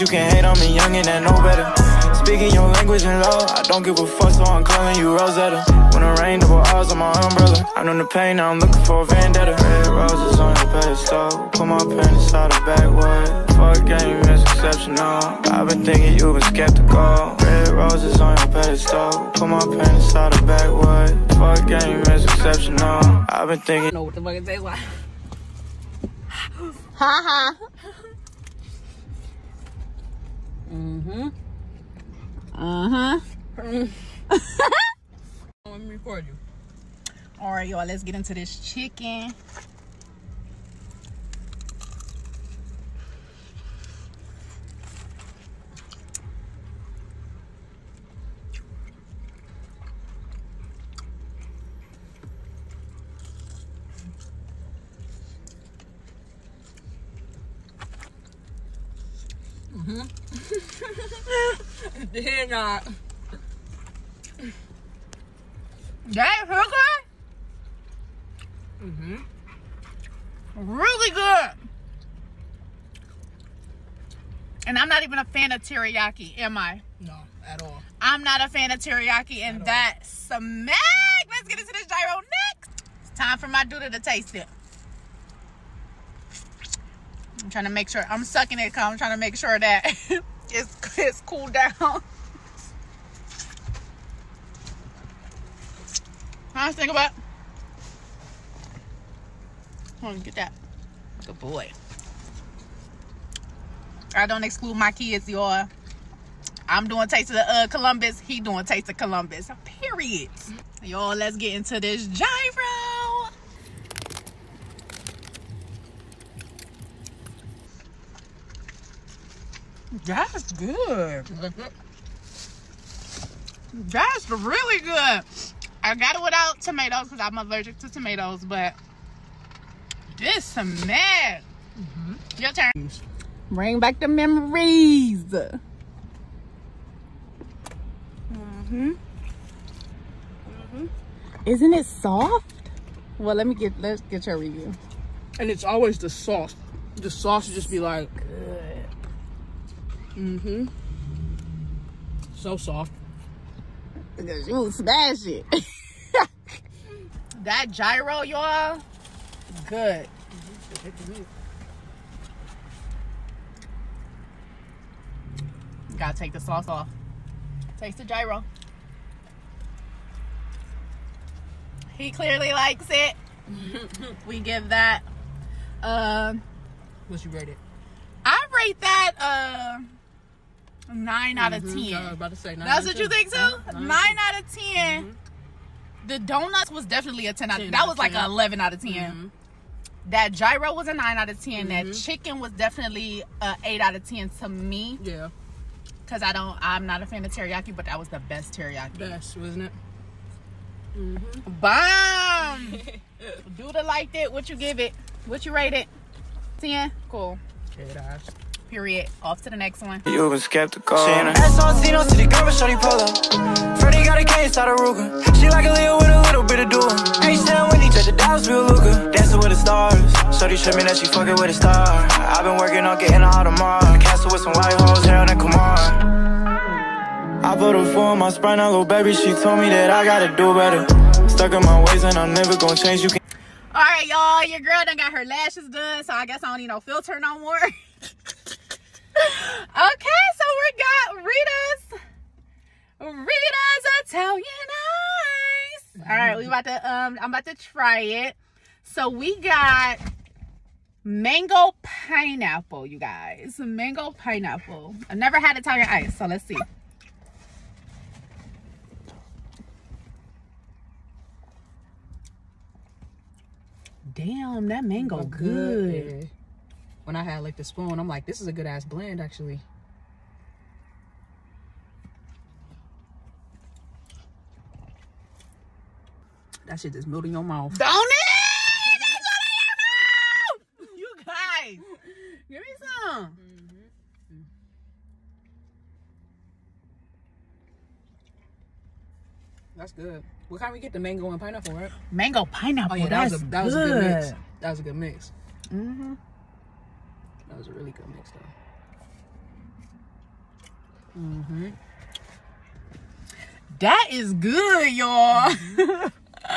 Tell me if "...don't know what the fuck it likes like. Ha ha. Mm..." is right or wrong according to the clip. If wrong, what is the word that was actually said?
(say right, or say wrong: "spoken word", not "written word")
wrong: "tastes", not "likes".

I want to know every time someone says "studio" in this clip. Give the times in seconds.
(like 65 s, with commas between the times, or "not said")
not said.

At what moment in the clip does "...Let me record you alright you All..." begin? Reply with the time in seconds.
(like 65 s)
35 s.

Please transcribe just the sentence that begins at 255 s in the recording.
I've never had Italian ice, so let's see.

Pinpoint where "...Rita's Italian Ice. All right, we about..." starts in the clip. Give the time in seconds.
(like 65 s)
243 s.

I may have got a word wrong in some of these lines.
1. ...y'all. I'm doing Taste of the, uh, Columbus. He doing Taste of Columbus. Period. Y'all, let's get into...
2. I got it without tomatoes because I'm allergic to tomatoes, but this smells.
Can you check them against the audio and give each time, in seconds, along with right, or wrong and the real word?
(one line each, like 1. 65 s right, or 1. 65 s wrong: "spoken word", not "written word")
1. 105 s right
2. 125 s right.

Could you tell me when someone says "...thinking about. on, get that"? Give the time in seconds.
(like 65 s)
96 s.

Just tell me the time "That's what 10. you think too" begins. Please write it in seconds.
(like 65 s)
182 s.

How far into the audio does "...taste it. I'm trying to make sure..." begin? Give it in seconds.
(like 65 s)
84 s.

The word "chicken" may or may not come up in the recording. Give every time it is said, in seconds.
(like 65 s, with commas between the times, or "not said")
38 s, 191 s.